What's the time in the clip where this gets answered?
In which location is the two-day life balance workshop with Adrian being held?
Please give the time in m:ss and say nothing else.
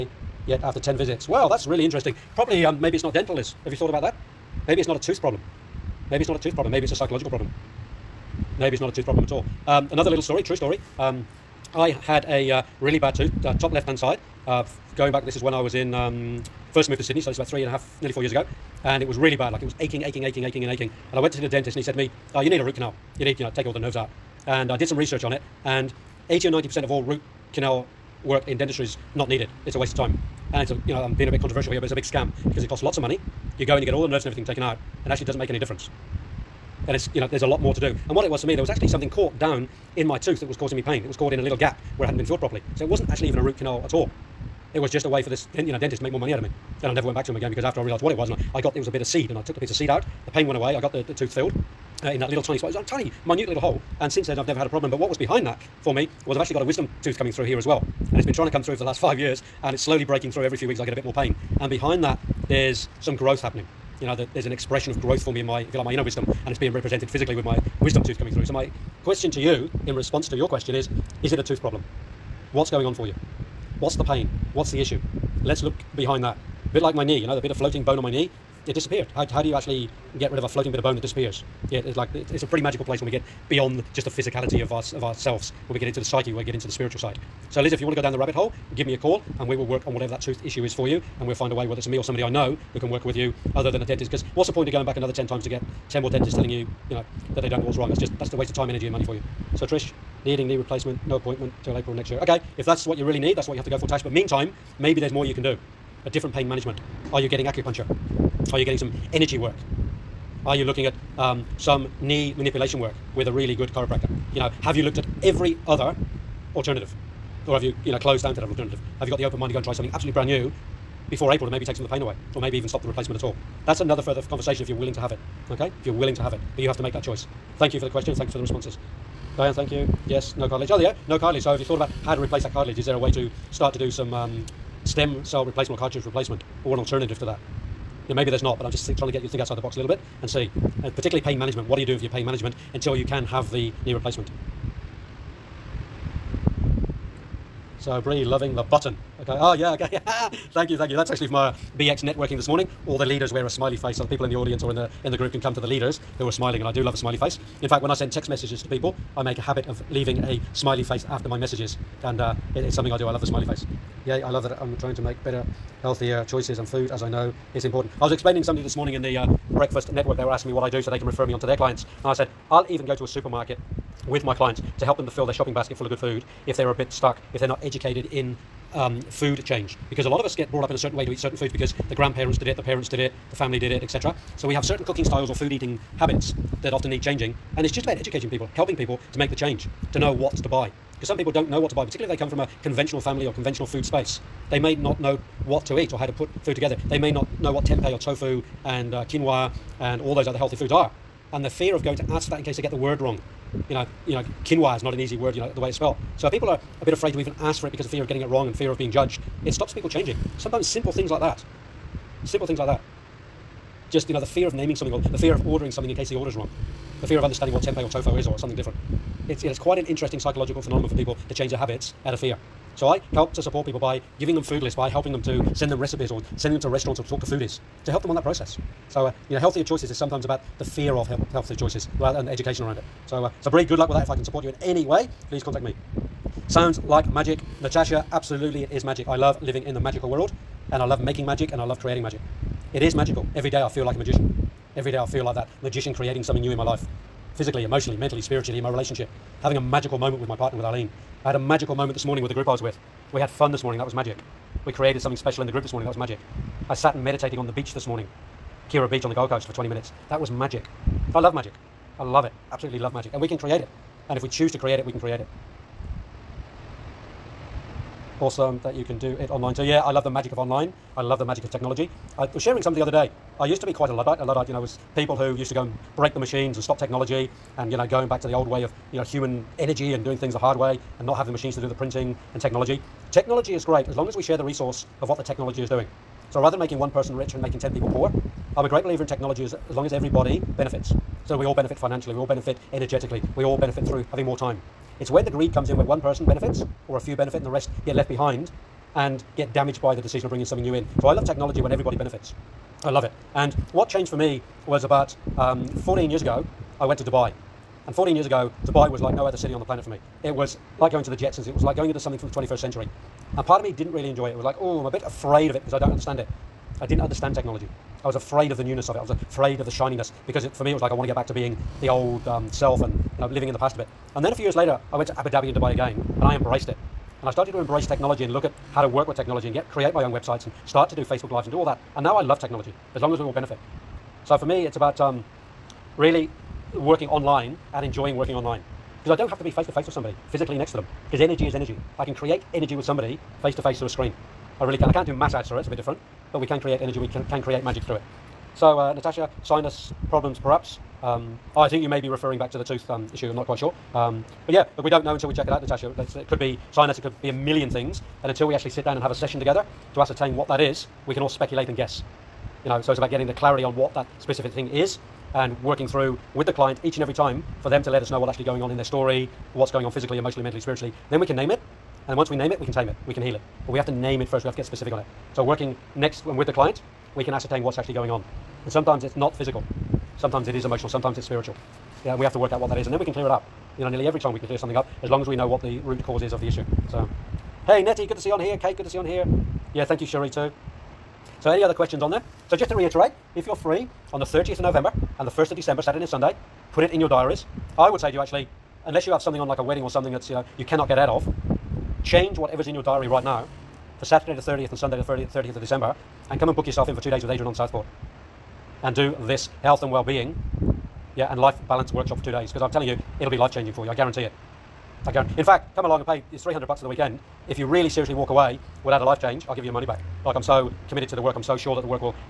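6:47.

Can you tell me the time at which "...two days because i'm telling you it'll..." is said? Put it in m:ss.
6:52.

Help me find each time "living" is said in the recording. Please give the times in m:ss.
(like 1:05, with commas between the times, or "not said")
3:59, 5:23.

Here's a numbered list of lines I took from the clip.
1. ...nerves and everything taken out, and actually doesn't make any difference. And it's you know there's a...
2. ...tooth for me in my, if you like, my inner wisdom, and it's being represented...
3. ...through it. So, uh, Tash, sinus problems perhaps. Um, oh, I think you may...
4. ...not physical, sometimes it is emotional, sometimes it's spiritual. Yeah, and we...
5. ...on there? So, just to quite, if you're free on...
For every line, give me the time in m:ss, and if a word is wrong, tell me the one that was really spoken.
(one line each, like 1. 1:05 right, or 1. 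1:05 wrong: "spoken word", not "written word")
1. 0:34 right
2. 1:04 wrong: "growth", not "tooth"
3. 5:47 wrong: "Natasha", not "Tash"
4. 6:19 right
5. 6:32 wrong: "reiterate", not "quite".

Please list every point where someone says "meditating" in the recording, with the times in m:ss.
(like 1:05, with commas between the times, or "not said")
4:17.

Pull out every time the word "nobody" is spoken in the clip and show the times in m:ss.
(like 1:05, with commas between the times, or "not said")
not said.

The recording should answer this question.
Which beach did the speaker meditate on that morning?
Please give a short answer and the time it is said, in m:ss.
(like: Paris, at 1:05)
Kirra Beach, at 4:18.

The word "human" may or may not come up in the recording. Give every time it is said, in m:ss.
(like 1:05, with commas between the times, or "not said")
4:39.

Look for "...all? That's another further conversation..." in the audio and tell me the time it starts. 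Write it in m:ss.
2:03.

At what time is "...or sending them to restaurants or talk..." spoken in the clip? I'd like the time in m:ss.
3:46.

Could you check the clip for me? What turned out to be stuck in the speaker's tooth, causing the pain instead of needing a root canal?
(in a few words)
a bit of seed.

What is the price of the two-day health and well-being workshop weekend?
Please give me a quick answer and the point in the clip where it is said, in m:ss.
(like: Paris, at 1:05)
300 bucks, at 6:56.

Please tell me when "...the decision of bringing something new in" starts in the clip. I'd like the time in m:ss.
4:59.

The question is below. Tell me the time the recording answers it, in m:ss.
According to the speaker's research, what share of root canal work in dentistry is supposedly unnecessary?
0:26.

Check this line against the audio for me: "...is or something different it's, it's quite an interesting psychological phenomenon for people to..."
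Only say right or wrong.
right.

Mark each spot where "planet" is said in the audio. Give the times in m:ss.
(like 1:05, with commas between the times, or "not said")
5:09.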